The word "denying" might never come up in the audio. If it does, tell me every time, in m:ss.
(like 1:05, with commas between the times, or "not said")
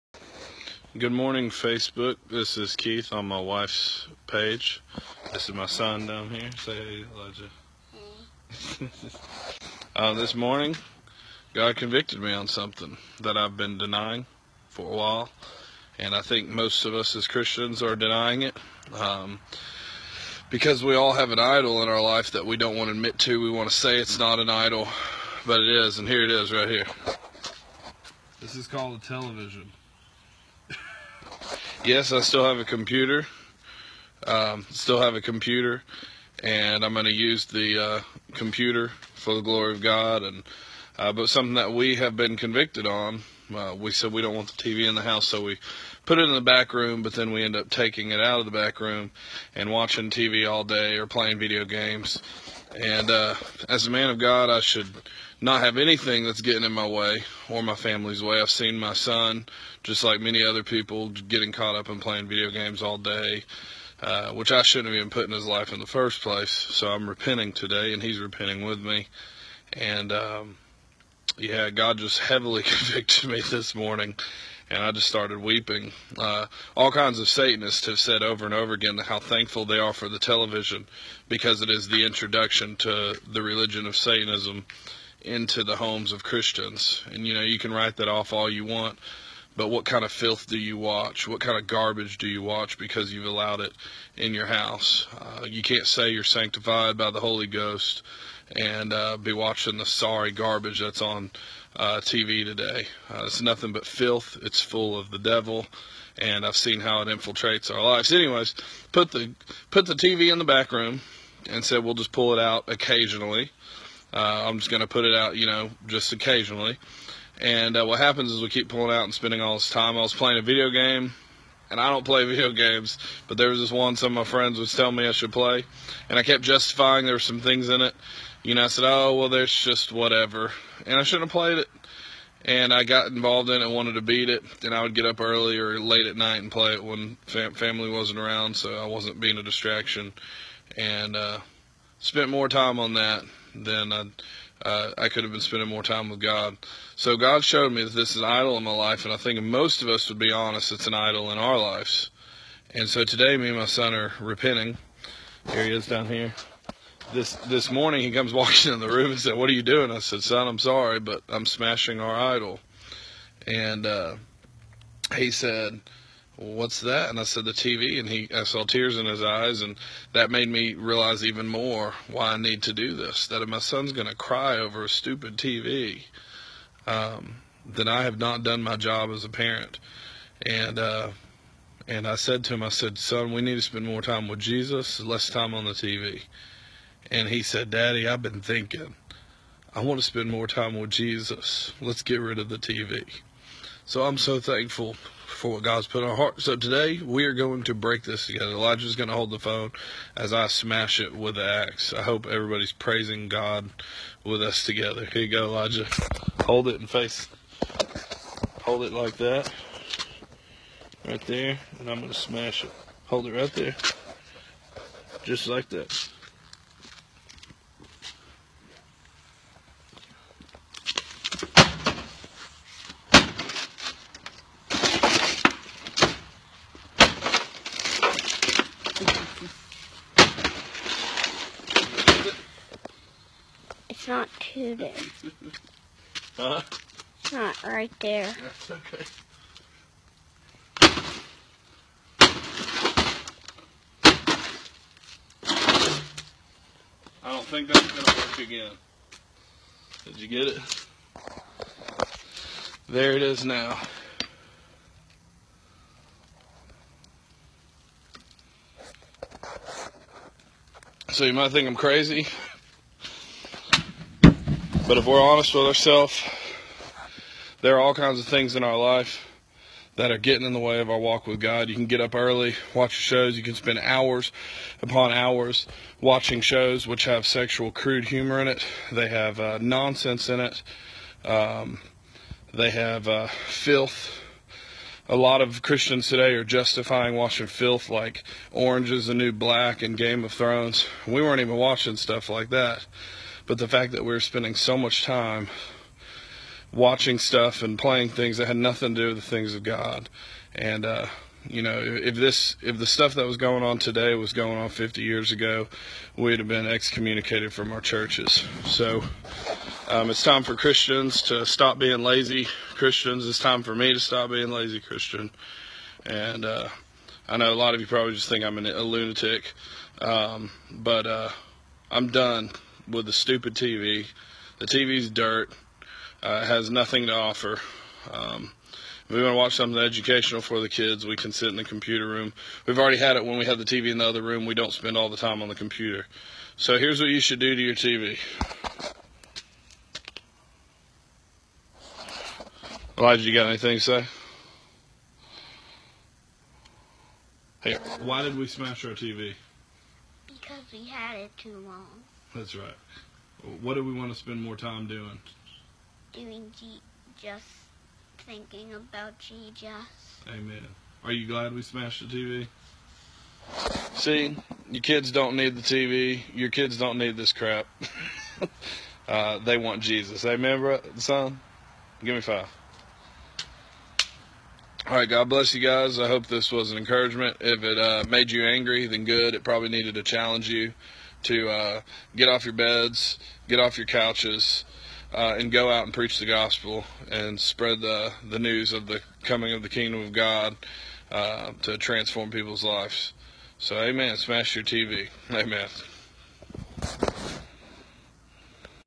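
0:13, 0:17.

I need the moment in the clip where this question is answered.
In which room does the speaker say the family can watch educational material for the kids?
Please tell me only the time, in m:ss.
5:31.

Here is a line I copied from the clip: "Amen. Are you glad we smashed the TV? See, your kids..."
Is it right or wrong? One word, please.
right.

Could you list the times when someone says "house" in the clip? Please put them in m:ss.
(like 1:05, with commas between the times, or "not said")
0:45, 1:34.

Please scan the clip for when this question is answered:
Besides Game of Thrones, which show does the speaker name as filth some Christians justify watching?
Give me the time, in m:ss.
4:48.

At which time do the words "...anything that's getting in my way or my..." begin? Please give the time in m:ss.
0:55.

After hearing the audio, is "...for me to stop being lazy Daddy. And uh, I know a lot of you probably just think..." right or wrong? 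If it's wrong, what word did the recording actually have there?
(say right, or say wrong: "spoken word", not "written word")
wrong: "Christian", not "Daddy".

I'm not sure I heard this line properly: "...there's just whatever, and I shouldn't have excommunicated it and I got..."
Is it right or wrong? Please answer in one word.
wrong.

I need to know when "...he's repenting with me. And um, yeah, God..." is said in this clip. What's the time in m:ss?
1:08.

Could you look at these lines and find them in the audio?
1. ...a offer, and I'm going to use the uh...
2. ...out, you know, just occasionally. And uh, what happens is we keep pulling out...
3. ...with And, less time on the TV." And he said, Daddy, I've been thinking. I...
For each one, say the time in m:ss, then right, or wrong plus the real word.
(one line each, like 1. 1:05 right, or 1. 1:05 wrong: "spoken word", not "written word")
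1. 0:35 wrong: "computer", not "offer"
2. 1:55 right
3. 3:04 wrong: "Jesus", not "And".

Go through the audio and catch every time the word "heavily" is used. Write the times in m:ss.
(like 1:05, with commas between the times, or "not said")
1:12.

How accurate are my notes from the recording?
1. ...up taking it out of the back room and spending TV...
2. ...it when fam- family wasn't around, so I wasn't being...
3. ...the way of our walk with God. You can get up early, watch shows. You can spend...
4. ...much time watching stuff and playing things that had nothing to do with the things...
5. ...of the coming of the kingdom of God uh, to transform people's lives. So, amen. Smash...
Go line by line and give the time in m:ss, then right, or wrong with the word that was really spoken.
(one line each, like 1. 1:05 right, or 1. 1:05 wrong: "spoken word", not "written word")
1. 0:47 wrong: "watching", not "spending"
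2. 2:16 right
3. 4:30 right
4. 4:54 right
5. 6:28 right.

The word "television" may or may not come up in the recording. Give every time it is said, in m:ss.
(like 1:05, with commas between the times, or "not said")
0:29, 1:20.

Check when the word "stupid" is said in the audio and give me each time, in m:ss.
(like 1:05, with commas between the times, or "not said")
2:54, 5:23.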